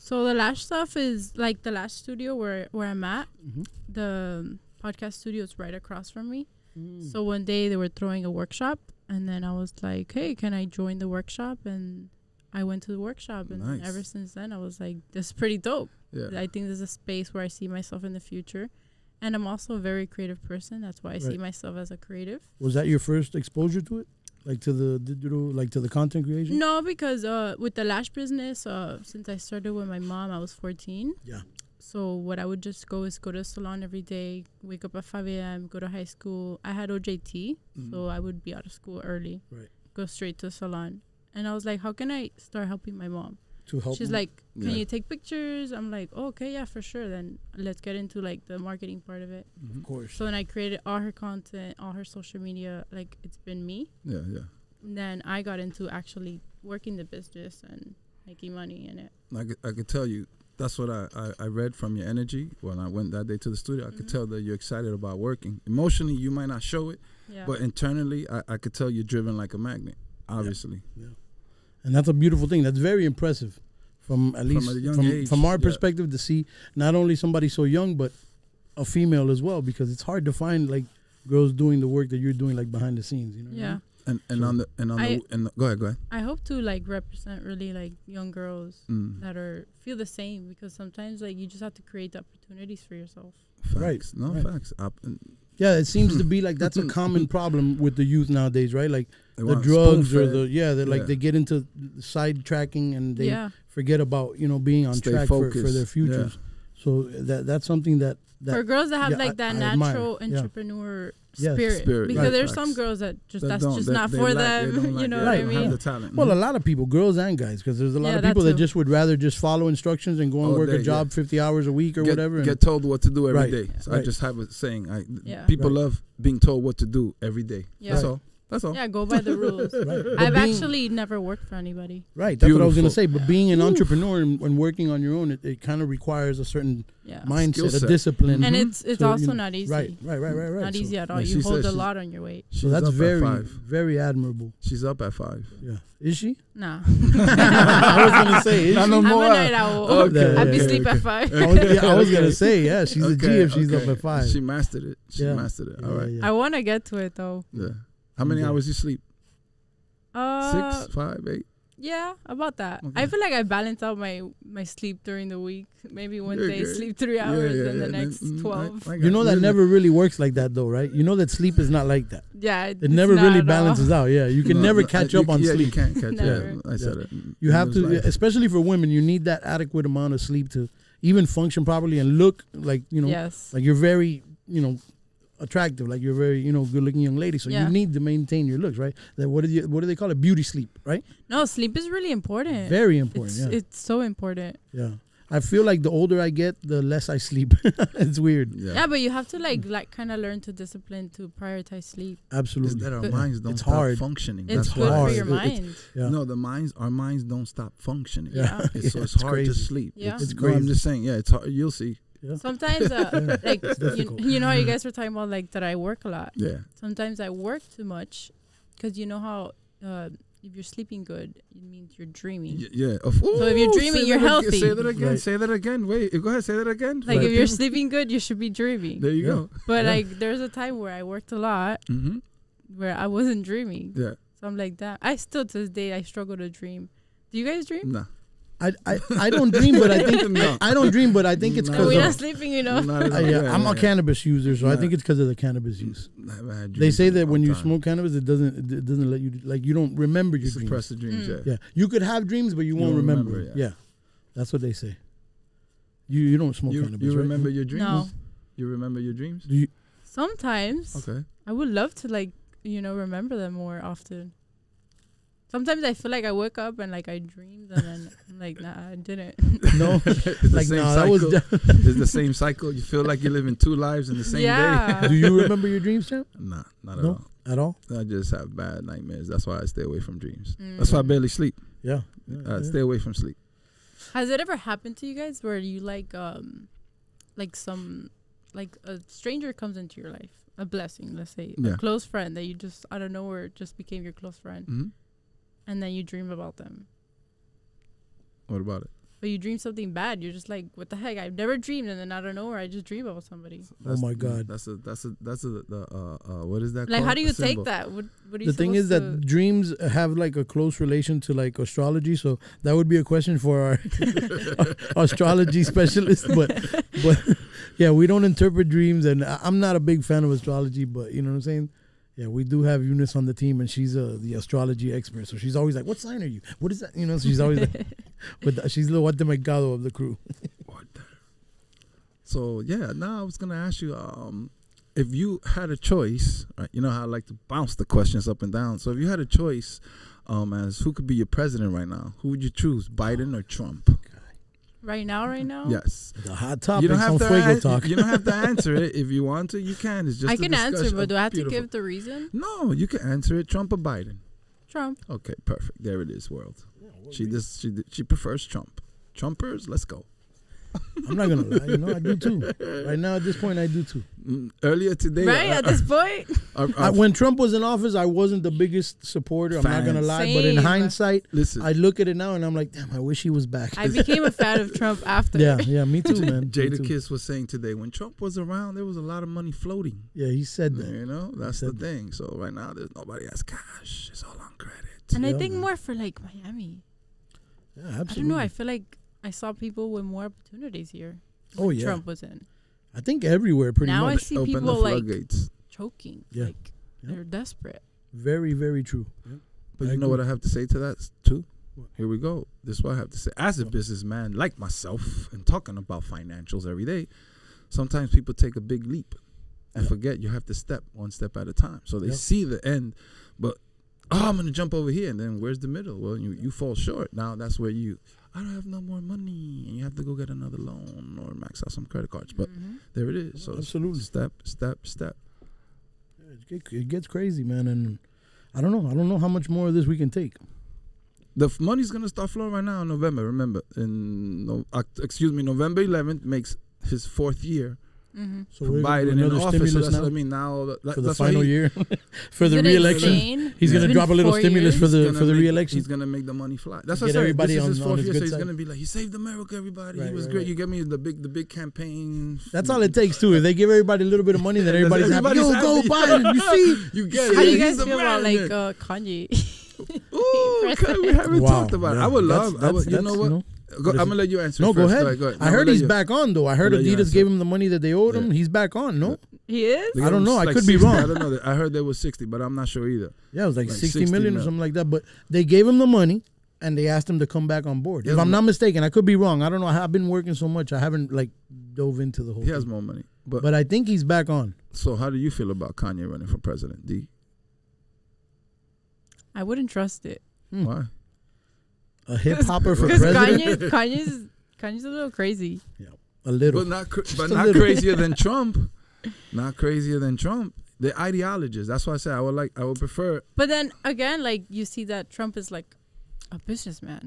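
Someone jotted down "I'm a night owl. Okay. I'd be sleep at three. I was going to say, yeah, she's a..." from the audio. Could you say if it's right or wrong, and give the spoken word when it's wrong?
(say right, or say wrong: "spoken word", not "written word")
wrong: "five", not "three".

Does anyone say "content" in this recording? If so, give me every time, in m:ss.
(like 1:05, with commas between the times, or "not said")
0:25, 0:51.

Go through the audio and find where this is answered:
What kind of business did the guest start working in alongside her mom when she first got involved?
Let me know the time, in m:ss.
0:27.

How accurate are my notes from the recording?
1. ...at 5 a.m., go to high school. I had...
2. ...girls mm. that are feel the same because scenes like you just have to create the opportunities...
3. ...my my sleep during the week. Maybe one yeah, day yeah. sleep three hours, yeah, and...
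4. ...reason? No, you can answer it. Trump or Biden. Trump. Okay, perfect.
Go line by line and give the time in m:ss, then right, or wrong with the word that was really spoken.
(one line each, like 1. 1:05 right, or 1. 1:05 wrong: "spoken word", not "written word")
1. 0:34 right
2. 1:28 wrong: "sometimes", not "scenes"
3. 2:43 right
4. 5:51 right.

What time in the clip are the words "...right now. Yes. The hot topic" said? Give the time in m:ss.
5:45.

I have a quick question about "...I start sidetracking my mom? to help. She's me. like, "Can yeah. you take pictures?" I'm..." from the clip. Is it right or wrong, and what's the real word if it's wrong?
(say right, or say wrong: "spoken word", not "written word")
wrong: "helping", not "sidetracking".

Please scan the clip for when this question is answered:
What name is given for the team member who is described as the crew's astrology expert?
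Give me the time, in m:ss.
5:22.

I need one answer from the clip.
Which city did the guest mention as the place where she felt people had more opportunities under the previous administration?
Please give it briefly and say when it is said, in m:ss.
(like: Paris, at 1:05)
Miami, at 6:26.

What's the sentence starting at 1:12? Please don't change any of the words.
That's very impressive from at least from, from, age, from, our yeah.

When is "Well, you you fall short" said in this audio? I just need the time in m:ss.
6:55.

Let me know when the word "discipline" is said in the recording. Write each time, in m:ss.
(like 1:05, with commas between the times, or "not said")
2:17, 3:20.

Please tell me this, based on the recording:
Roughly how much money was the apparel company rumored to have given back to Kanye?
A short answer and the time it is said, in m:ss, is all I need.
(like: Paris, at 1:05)
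60 million, at 7:53.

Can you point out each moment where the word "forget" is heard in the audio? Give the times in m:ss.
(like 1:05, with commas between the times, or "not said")
1:43, 6:49.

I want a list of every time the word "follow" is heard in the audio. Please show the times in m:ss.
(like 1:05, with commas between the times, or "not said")
1:59.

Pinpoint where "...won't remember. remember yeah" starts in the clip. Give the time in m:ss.
4:12.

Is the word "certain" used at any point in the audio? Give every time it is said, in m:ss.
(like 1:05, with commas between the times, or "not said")
2:16.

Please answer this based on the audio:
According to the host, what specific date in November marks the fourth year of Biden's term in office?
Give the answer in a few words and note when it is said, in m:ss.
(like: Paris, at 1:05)
November 11th, at 7:15.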